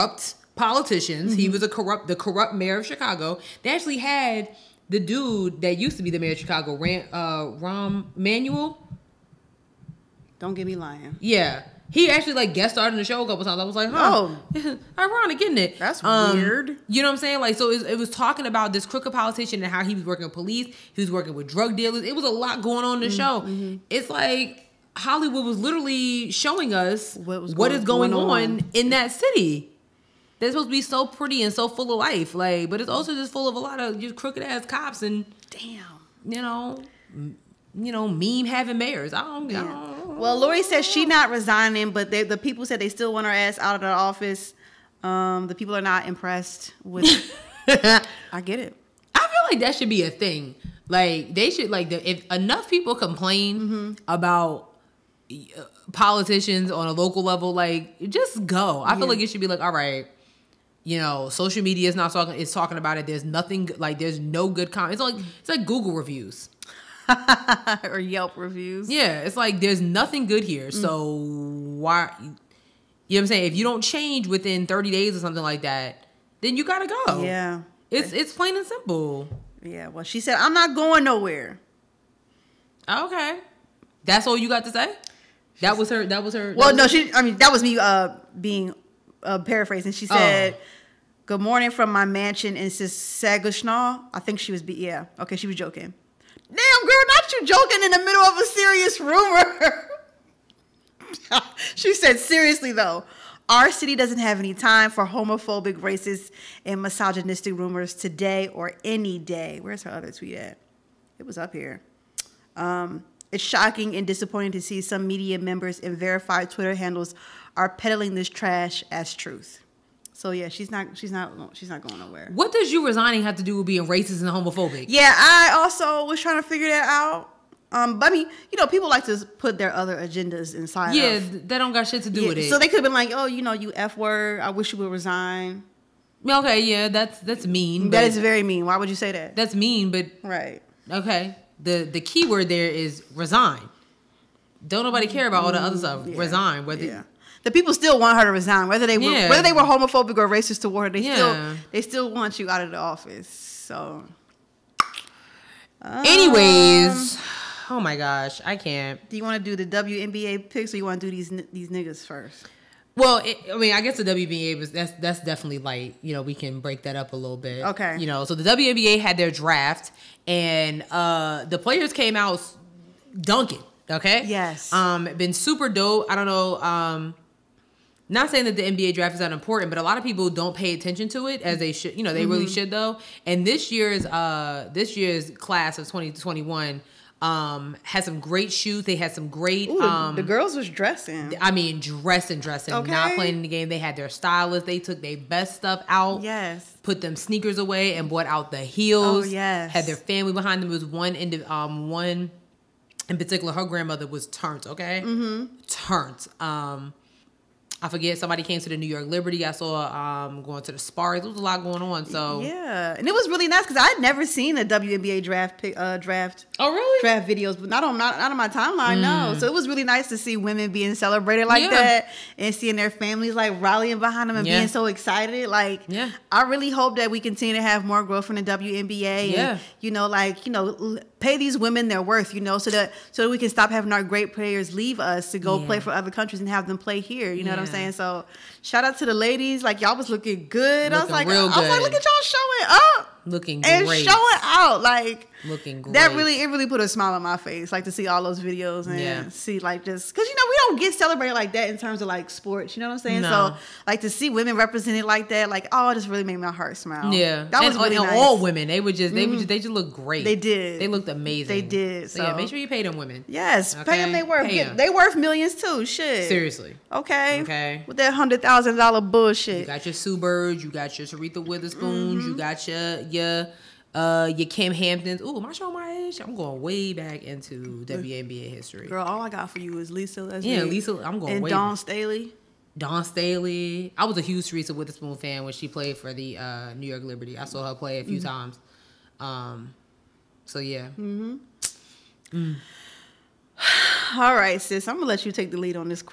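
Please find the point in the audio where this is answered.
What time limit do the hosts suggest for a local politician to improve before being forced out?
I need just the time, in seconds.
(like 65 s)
74 s.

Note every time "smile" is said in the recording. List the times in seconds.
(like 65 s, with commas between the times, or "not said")
246 s, 256 s.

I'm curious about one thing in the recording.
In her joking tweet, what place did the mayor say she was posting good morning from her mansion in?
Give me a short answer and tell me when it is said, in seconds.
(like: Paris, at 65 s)
Sagushnaw, at 92 s.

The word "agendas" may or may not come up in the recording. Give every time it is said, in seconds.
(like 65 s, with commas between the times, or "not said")
129 s.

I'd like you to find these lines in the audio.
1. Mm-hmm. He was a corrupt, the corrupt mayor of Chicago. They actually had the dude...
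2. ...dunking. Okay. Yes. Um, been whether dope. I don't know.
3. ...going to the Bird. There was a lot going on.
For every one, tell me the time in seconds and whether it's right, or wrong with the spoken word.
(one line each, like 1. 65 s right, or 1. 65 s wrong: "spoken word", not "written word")
1. 1 s right
2. 173 s wrong: "super", not "whether"
3. 210 s wrong: "Spurs", not "Bird".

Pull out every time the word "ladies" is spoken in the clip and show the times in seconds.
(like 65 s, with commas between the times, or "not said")
239 s.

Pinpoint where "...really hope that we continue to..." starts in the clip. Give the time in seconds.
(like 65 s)
226 s.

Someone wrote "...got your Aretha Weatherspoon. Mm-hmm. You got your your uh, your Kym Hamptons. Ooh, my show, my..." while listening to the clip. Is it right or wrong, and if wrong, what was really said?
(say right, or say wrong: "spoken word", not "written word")
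right.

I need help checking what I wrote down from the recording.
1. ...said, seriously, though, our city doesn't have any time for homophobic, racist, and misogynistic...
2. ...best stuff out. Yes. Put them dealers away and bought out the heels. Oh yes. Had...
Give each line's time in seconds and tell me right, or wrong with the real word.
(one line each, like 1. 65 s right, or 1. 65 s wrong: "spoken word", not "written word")
1. 101 s right
2. 195 s wrong: "sneakers", not "dealers".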